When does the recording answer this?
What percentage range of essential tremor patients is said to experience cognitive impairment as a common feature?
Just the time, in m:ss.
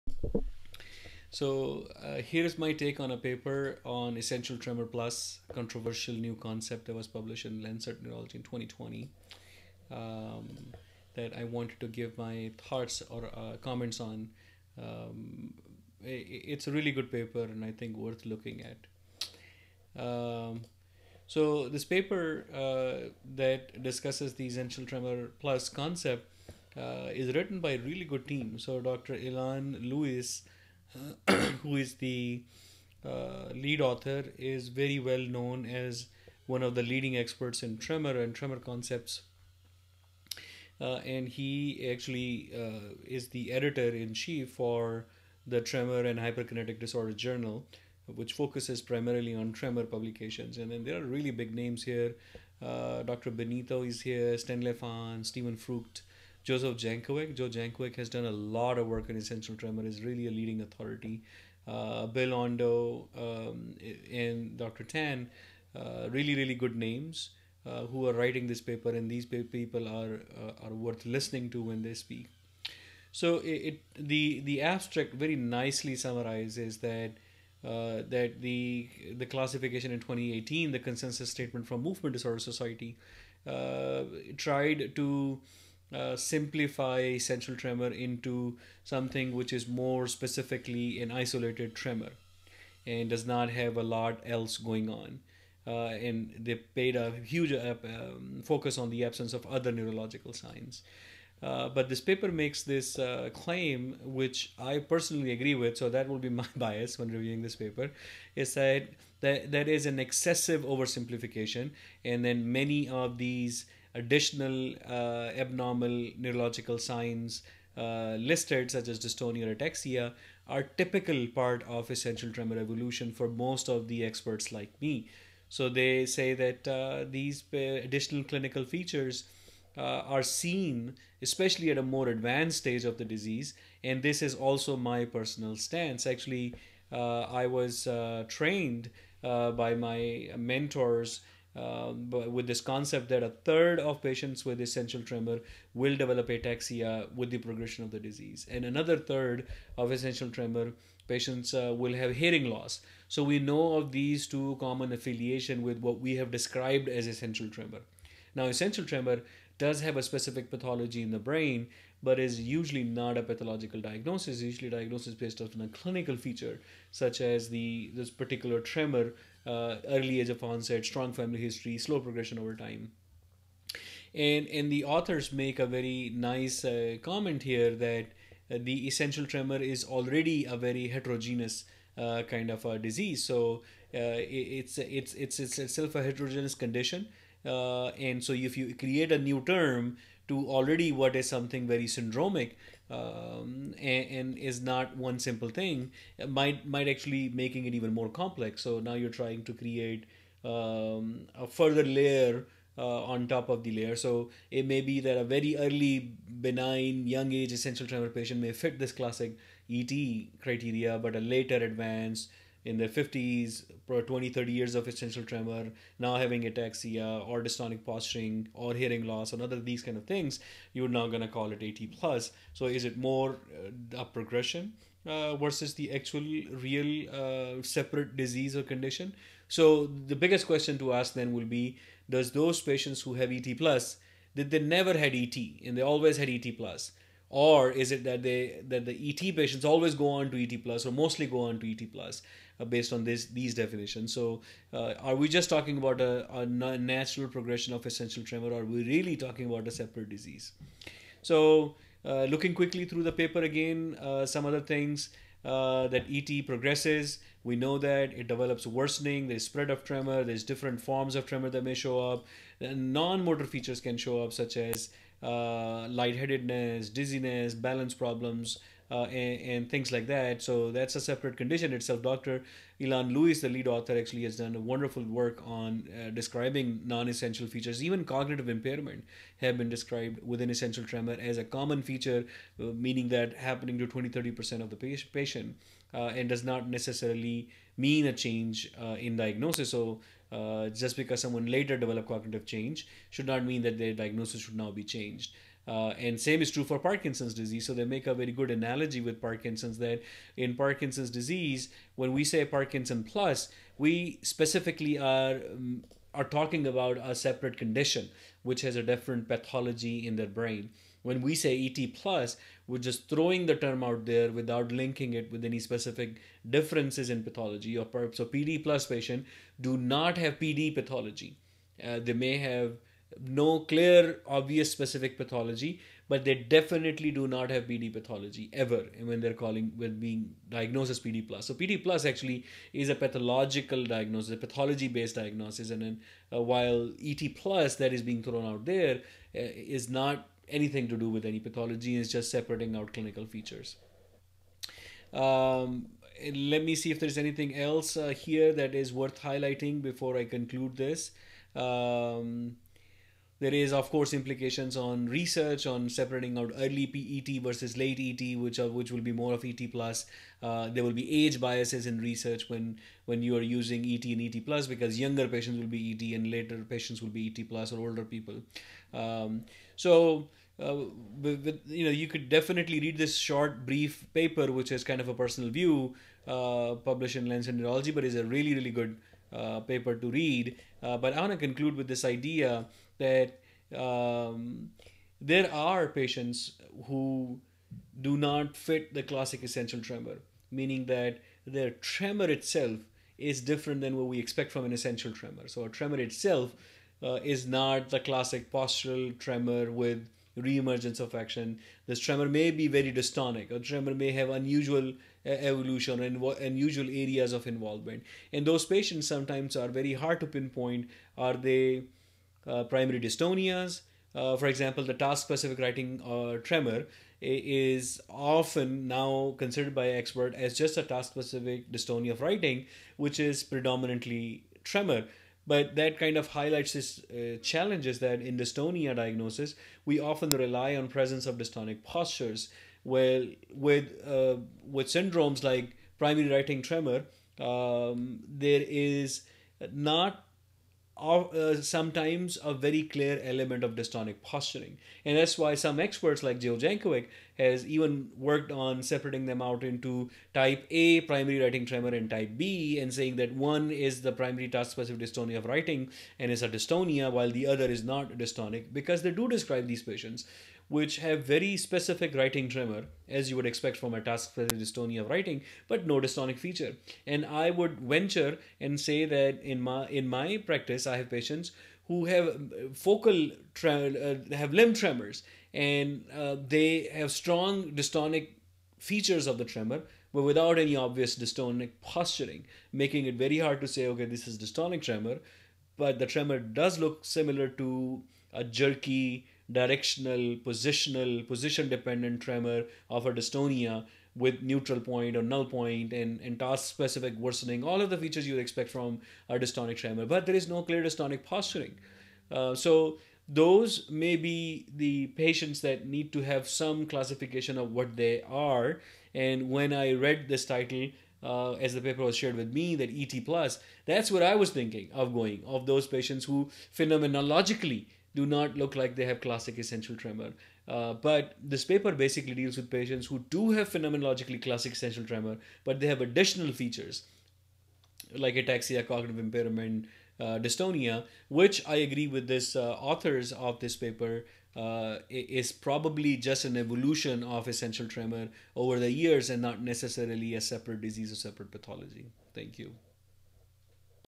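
4:43.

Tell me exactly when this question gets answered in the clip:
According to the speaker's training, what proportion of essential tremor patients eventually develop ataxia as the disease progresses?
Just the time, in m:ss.
2:23.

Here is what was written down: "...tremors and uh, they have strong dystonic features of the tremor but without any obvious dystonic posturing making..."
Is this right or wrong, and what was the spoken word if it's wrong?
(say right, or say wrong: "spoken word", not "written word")
right.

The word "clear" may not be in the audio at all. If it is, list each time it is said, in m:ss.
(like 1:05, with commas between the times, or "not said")
5:23, 7:22, 8:20.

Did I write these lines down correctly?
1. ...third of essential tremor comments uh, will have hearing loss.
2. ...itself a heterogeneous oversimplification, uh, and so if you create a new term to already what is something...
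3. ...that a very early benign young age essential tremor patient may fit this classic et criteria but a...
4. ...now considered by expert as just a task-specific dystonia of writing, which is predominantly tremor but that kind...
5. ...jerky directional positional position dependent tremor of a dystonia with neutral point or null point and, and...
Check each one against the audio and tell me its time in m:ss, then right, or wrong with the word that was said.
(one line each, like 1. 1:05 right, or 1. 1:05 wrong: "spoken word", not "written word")
1. 2:28 wrong: "patients", not "comments"
2. 3:05 wrong: "condition", not "oversimplification"
3. 3:24 right
4. 6:58 right
5. 8:08 right.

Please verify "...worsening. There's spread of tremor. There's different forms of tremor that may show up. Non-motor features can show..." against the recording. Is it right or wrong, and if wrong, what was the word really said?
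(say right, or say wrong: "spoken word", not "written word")
right.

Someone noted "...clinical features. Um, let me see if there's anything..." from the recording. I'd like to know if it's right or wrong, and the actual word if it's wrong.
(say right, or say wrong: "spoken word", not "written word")
right.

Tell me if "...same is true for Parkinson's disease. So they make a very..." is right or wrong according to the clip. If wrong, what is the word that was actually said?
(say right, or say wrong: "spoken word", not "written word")
right.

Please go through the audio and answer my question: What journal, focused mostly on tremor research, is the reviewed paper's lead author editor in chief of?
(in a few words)
Tremor and Hyperkinetic Disorder Journal.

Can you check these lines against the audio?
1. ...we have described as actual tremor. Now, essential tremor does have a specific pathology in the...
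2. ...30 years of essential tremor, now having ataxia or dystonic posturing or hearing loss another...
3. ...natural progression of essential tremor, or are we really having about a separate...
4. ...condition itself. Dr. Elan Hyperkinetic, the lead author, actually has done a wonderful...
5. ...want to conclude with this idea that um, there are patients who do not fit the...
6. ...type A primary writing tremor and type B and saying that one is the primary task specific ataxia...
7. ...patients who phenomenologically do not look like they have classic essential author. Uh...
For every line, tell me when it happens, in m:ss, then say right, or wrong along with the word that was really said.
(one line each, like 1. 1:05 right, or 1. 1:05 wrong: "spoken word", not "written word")
1. 2:35 wrong: "essential", not "actual"
2. 3:34 right
3. 4:06 wrong: "talking", not "having"
4. 4:31 wrong: "Louis", not "Hyperkinetic"
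5. 6:21 right
6. 7:30 wrong: "dystonia", not "ataxia"
7. 8:35 wrong: "tremor", not "author".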